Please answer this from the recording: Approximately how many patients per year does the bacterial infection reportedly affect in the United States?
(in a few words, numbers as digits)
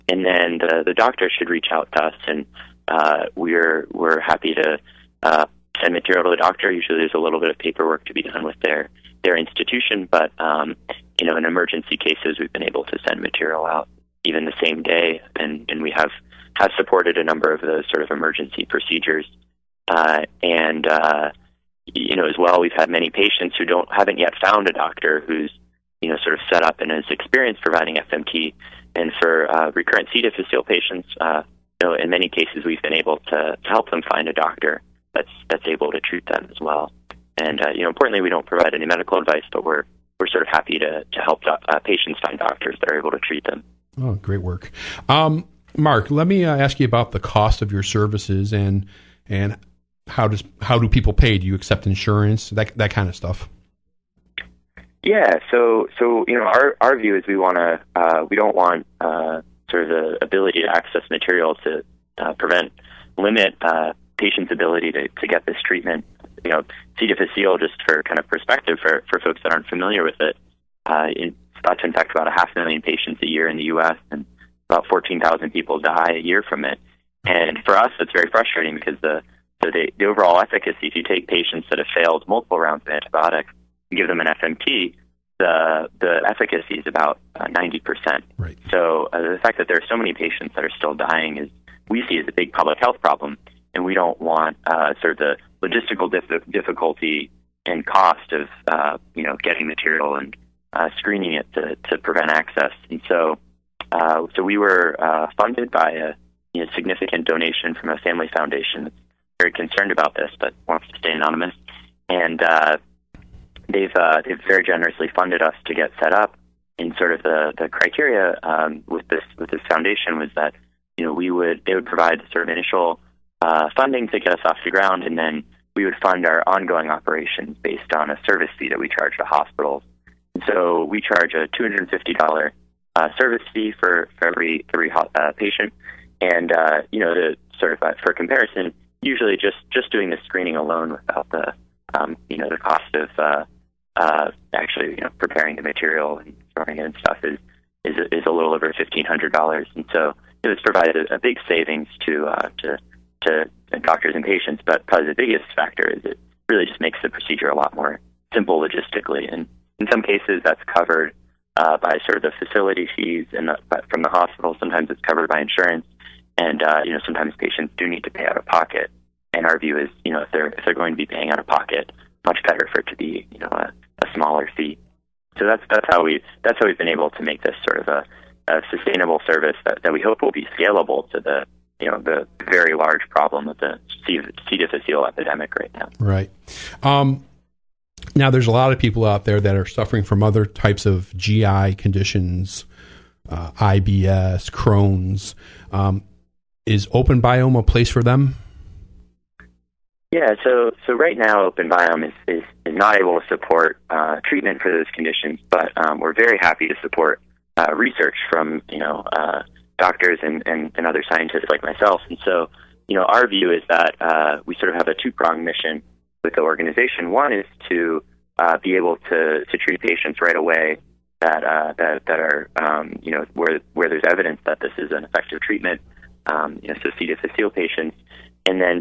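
half million.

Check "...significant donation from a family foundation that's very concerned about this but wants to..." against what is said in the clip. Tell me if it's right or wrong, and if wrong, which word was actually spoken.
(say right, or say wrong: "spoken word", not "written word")
right.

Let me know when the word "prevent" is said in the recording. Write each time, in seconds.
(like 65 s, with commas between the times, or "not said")
62 s, 101 s.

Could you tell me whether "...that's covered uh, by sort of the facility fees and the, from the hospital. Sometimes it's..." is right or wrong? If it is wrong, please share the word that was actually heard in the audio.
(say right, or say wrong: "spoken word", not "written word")
right.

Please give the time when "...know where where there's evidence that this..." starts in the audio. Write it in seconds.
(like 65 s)
223 s.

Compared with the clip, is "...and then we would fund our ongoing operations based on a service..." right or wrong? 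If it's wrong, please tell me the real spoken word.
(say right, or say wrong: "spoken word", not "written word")
right.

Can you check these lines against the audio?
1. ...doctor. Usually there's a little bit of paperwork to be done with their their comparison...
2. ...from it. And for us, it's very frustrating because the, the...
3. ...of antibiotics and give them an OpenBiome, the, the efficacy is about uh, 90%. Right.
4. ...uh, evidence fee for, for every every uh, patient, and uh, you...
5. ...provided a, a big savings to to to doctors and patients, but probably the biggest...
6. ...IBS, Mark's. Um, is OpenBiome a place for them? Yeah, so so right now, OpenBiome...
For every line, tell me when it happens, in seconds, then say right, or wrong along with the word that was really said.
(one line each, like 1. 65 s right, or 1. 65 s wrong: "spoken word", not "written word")
1. 6 s wrong: "institution", not "comparison"
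2. 76 s right
3. 82 s wrong: "FMT", not "OpenBiome"
4. 132 s wrong: "service", not "evidence"
5. 150 s right
6. 193 s wrong: "Crohn", not "Mark".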